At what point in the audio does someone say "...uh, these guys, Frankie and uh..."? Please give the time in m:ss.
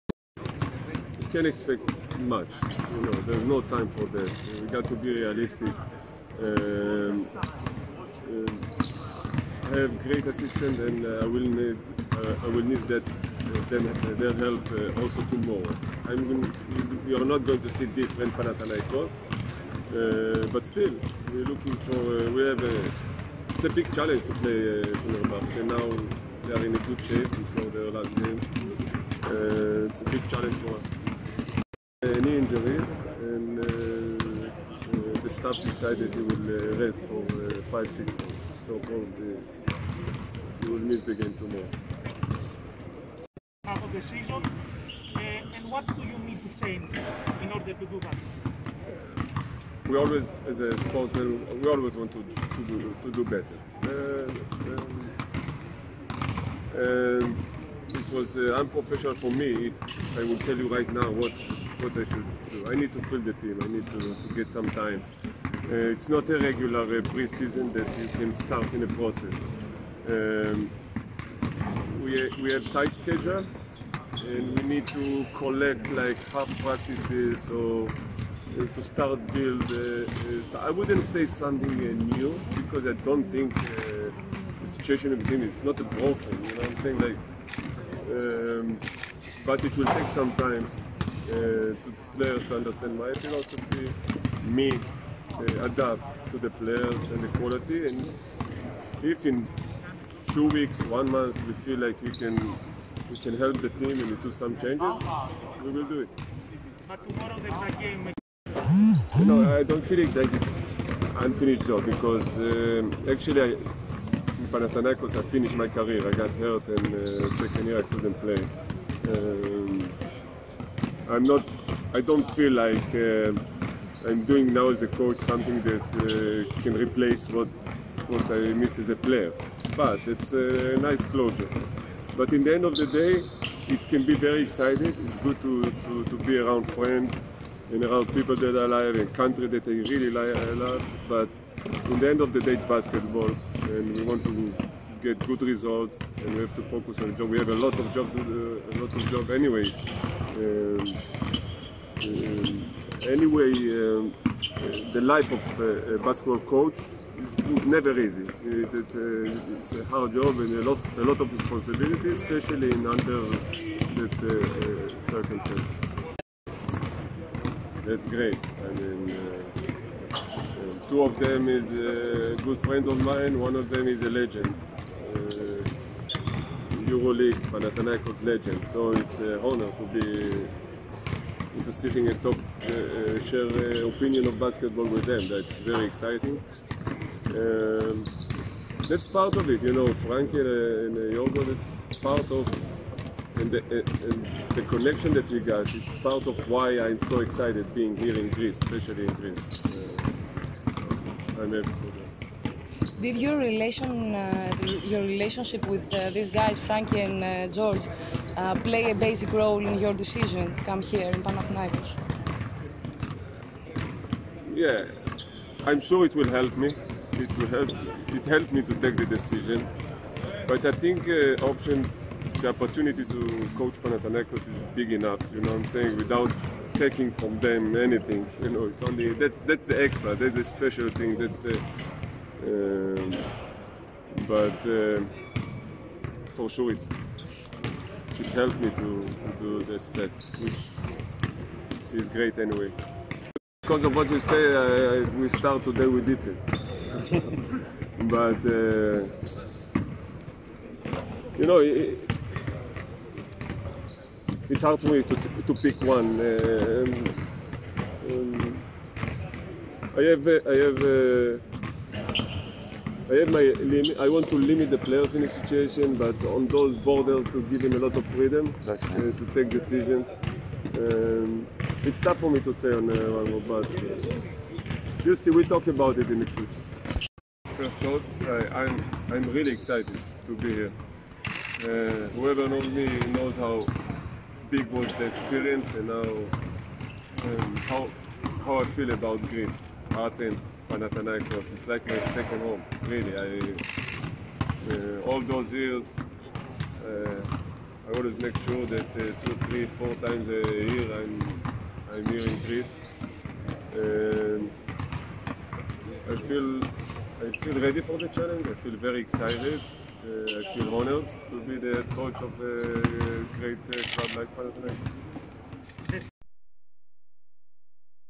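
3:25.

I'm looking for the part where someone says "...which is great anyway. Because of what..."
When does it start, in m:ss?
4:00.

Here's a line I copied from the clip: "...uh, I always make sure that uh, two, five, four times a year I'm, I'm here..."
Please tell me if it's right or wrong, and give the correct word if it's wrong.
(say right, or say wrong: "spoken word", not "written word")
wrong: "three", not "five".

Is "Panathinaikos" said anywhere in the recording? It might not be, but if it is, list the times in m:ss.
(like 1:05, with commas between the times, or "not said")
0:18, 1:54, 2:57, 3:31, 3:43, 4:50, 5:14.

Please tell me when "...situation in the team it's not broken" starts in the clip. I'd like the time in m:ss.
1:24.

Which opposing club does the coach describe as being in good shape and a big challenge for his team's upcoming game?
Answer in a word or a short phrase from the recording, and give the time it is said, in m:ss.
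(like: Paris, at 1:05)
Fenerbahce, at 0:25.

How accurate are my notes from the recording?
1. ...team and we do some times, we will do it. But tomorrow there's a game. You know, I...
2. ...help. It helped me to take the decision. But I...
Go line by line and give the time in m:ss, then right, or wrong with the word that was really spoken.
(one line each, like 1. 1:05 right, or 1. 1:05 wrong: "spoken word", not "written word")
1. 1:43 wrong: "changes", not "times"
2. 3:37 right.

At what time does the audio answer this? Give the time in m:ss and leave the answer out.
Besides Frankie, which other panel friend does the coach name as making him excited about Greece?
3:11.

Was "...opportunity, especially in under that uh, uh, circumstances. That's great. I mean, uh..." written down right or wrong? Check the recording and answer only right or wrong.
wrong.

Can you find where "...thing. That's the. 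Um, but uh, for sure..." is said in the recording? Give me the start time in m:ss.
3:50.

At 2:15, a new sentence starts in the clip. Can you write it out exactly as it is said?
It's good to, to, to be around friends and around people that I love and country that I really love.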